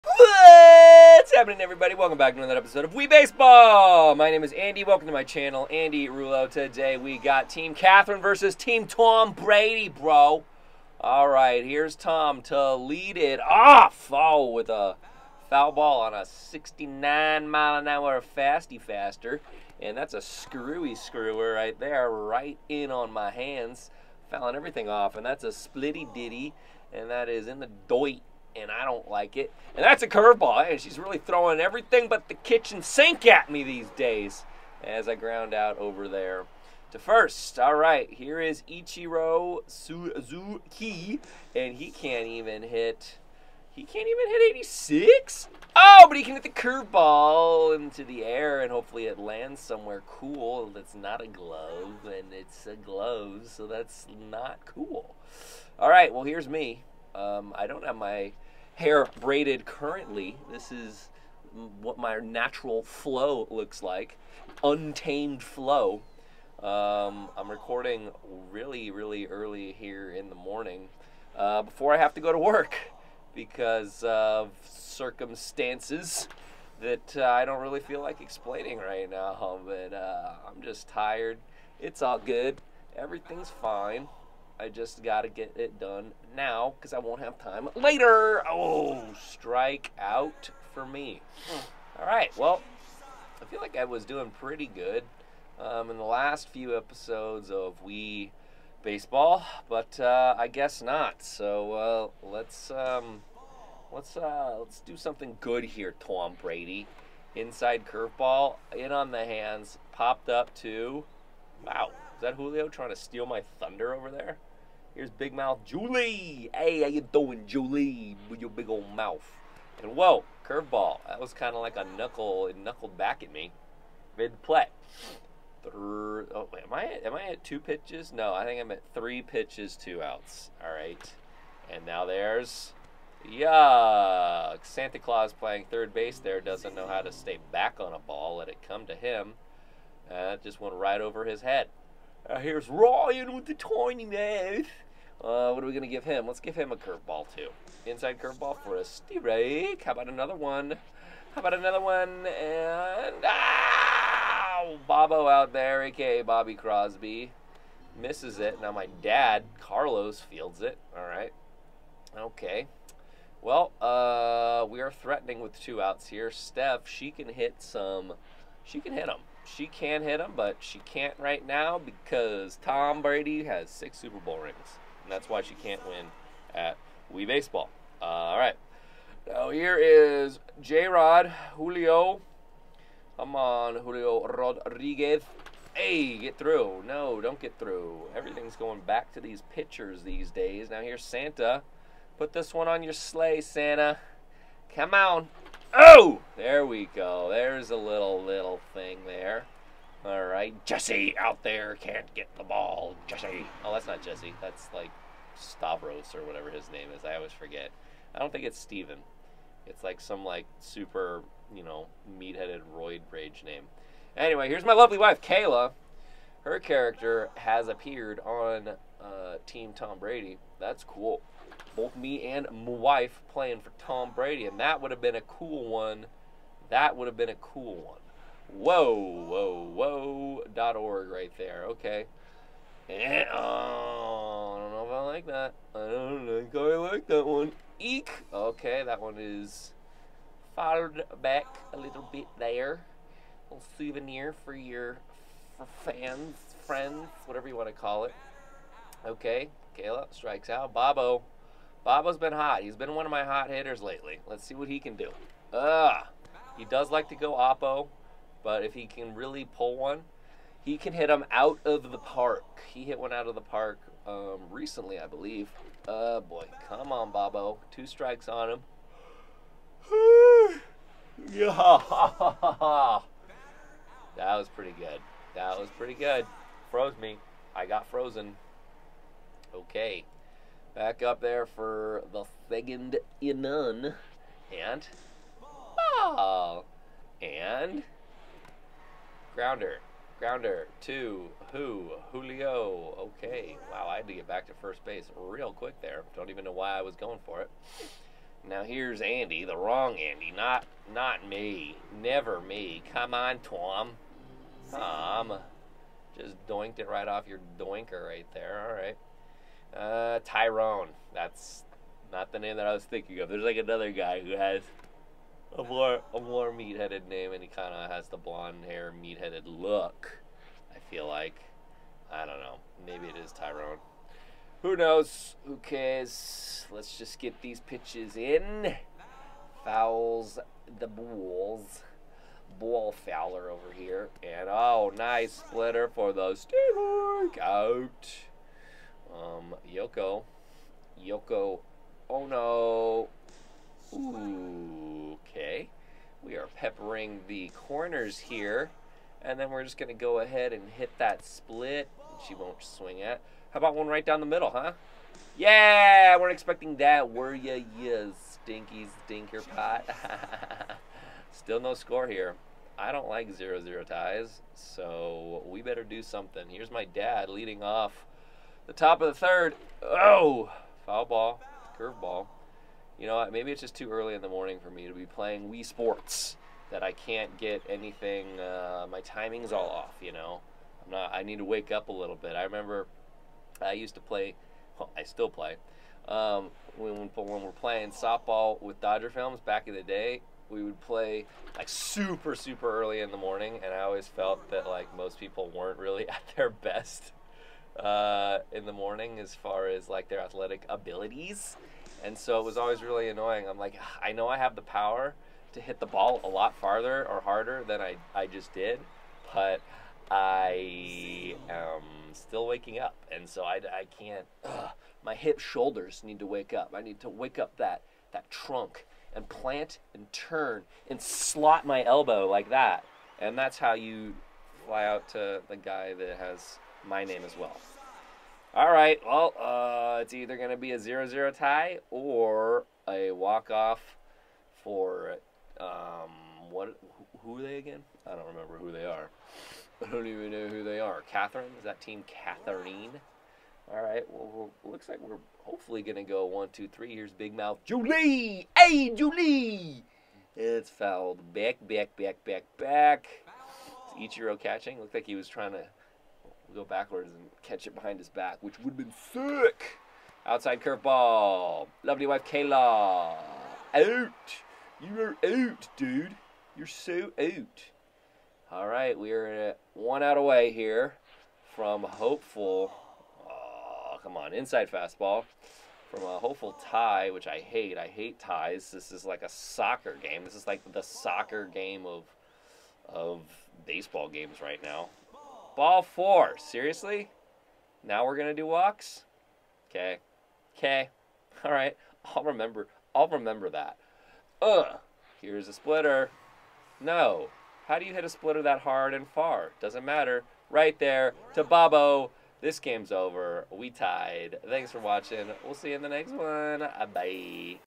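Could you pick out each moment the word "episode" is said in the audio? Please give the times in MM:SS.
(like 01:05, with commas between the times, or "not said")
00:02, 01:36.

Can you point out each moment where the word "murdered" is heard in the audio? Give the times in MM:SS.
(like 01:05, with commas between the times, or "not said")
not said.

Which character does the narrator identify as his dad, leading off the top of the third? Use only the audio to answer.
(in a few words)
Carlos.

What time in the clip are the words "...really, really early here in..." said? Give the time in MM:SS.
01:08.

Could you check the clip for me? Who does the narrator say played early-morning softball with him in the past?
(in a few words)
Dodger films.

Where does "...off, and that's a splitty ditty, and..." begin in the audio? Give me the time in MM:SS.
00:24.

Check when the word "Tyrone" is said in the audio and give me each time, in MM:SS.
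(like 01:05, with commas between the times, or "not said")
05:10, 05:23.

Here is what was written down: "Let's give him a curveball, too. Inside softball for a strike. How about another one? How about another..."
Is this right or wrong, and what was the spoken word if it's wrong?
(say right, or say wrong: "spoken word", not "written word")
wrong: "curveball", not "softball".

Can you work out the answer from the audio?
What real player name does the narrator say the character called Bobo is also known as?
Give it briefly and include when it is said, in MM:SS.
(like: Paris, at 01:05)
Bobby Crosby, at 02:36.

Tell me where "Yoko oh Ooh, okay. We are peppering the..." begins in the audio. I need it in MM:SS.
05:41.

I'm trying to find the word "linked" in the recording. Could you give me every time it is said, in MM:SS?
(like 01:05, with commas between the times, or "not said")
not said.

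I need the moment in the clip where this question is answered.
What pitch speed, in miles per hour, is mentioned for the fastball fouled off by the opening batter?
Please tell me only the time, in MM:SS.
00:16.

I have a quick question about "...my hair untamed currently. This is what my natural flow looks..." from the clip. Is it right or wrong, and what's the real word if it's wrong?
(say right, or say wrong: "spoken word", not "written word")
wrong: "braided", not "untamed".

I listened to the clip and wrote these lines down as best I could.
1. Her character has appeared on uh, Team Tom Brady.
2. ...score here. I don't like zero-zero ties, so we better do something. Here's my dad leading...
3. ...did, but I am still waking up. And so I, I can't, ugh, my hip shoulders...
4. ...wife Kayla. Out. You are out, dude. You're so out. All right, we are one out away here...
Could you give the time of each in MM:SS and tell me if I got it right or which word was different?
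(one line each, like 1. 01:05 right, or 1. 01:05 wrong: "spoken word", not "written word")
1. 03:36 right
2. 06:01 right
3. 06:48 right
4. 07:42 right.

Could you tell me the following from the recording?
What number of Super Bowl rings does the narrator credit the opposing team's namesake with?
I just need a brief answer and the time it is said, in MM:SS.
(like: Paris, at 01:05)
6, at 02:53.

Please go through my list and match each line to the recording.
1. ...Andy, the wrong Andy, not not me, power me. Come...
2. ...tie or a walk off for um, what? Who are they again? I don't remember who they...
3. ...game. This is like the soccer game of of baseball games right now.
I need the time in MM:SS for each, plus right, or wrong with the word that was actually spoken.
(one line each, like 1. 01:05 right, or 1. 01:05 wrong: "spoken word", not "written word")
1. 04:59 wrong: "never", not "power"
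2. 07:11 right
3. 08:00 right.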